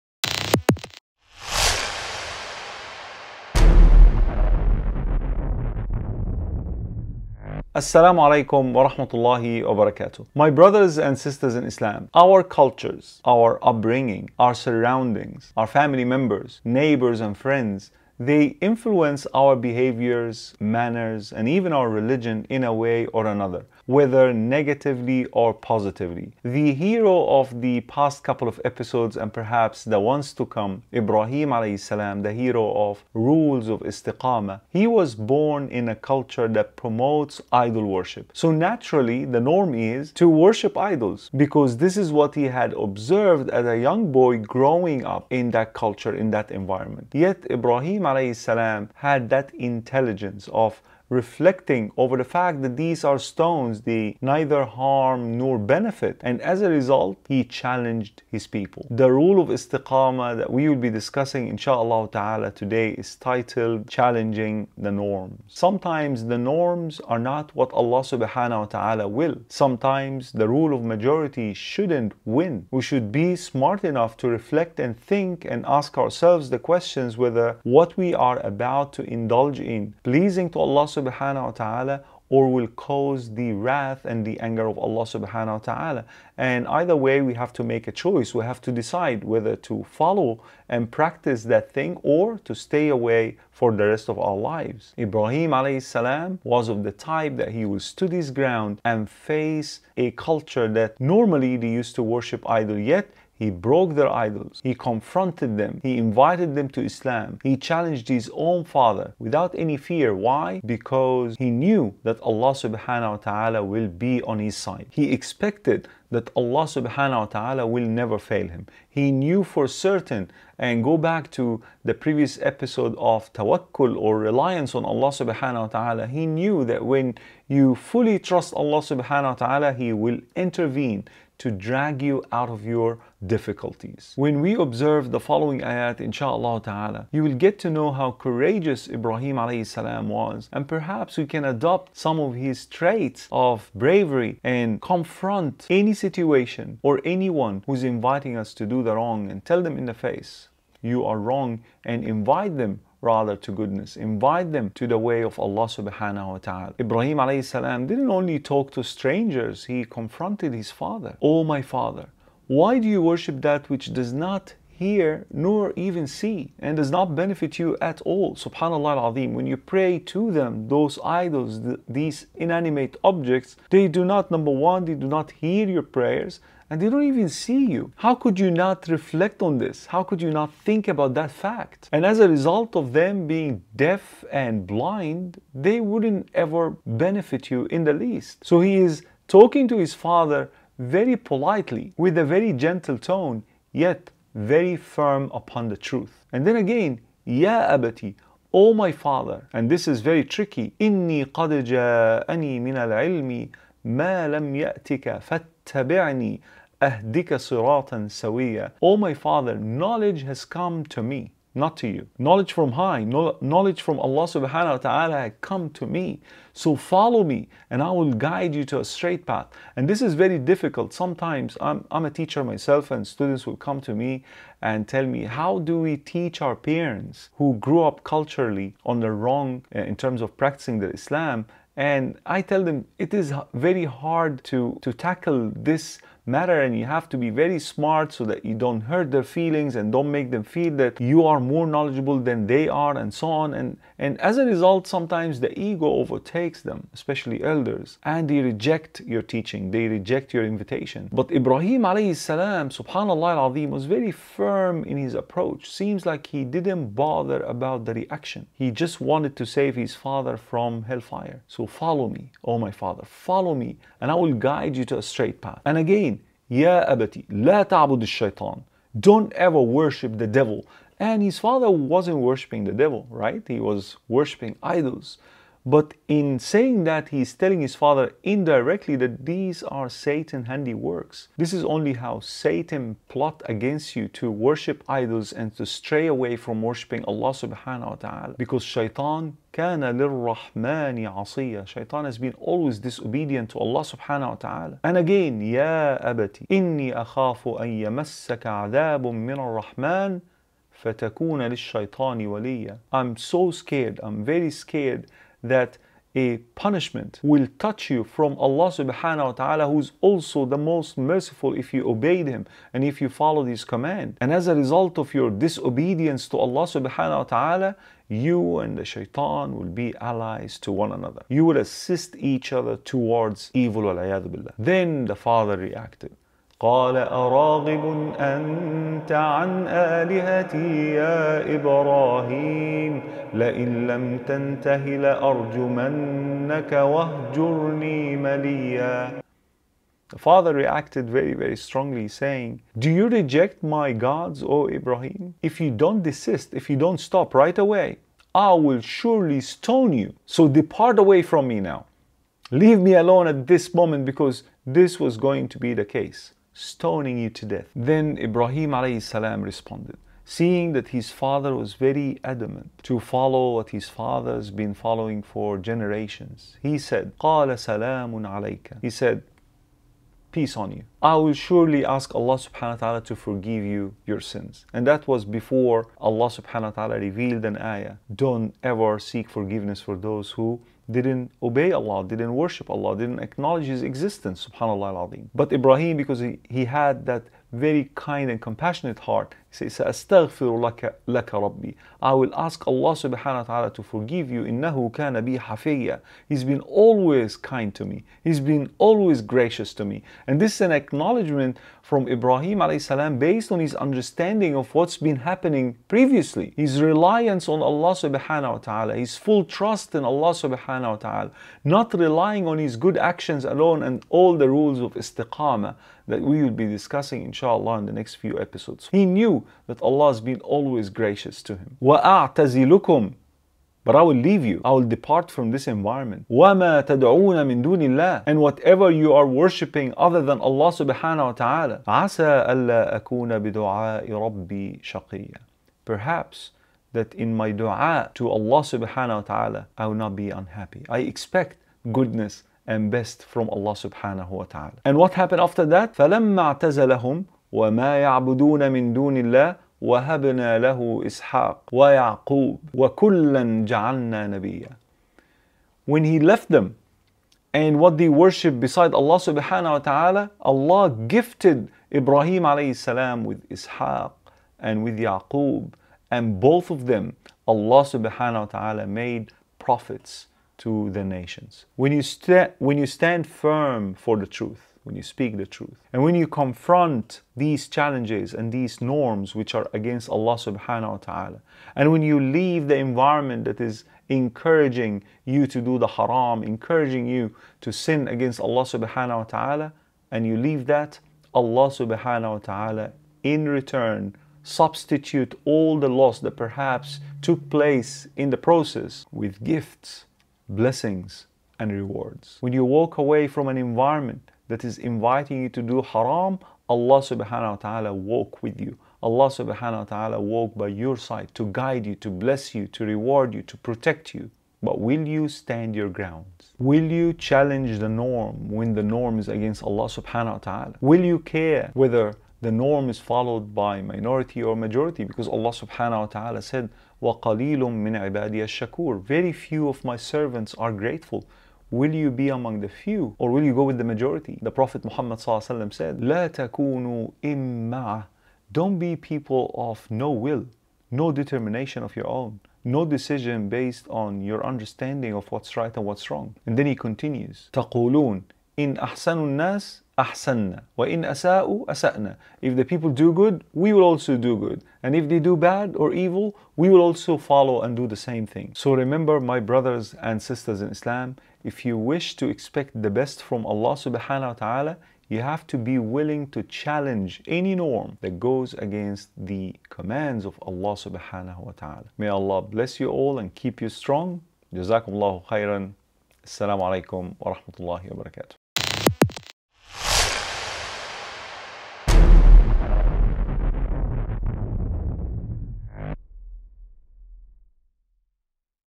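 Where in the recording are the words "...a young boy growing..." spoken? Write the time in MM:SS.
00:43.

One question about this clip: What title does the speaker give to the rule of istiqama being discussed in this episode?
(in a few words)
Challenging the Norms.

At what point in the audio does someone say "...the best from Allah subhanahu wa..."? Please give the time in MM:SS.
09:22.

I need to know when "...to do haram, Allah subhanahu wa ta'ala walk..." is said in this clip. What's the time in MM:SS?
08:25.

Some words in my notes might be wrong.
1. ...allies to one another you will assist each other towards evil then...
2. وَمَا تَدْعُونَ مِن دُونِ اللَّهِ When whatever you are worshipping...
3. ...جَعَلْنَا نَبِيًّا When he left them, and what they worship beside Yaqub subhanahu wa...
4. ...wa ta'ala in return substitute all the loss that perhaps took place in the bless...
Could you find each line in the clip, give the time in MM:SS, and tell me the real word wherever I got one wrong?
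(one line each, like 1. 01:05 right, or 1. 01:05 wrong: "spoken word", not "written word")
1. 05:20 right
2. 07:06 wrong: "And", not "When"
3. 07:33 wrong: "Allah", not "Yaqub"
4. 08:12 wrong: "process", not "bless".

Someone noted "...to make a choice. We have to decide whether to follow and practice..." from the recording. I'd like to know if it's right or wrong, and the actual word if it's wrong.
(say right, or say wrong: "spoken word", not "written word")
right.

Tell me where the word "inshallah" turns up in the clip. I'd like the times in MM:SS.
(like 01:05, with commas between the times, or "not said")
01:01, 02:15, 06:57.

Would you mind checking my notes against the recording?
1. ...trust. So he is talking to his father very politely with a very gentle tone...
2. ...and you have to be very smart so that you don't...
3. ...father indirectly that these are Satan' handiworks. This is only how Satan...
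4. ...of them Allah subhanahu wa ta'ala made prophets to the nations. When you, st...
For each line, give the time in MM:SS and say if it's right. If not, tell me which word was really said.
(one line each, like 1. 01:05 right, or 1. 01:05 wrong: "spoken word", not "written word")
1. 03:07 wrong: "least", not "trust"
2. 03:56 right
3. 04:37 right
4. 07:46 right.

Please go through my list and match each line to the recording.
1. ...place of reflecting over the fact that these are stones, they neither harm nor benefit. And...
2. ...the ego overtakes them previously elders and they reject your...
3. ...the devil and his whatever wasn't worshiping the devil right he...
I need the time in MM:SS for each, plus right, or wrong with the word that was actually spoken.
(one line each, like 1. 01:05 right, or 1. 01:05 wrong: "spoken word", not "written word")
1. 00:49 wrong: "intelligence", not "place"
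2. 04:05 wrong: "especially", not "previously"
3. 04:30 wrong: "father", not "whatever".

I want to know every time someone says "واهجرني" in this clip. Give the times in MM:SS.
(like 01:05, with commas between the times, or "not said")
05:36.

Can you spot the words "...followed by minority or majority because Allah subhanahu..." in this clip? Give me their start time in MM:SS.
08:42.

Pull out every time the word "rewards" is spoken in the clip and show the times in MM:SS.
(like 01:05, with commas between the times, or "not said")
08:21, 08:32.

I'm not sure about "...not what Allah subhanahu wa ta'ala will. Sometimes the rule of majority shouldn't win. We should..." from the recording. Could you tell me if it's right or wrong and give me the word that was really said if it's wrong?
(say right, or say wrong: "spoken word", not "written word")
right.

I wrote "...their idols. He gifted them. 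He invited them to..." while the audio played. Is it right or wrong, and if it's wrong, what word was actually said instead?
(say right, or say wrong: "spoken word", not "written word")
wrong: "confronted", not "gifted".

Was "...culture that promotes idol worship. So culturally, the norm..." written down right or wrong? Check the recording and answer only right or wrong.
wrong.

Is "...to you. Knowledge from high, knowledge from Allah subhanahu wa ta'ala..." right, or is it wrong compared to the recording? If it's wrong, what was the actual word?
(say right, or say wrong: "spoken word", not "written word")
right.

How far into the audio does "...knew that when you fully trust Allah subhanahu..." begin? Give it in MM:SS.
02:06.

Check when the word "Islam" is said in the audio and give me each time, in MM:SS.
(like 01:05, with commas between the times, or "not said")
00:11, 01:46, 03:50, 09:20.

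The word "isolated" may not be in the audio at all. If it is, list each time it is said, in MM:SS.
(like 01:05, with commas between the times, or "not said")
not said.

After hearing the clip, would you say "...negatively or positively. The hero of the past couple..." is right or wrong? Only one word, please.
right.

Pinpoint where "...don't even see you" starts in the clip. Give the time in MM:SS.
02:56.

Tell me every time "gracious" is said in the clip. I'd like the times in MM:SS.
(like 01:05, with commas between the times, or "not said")
06:39, 07:00.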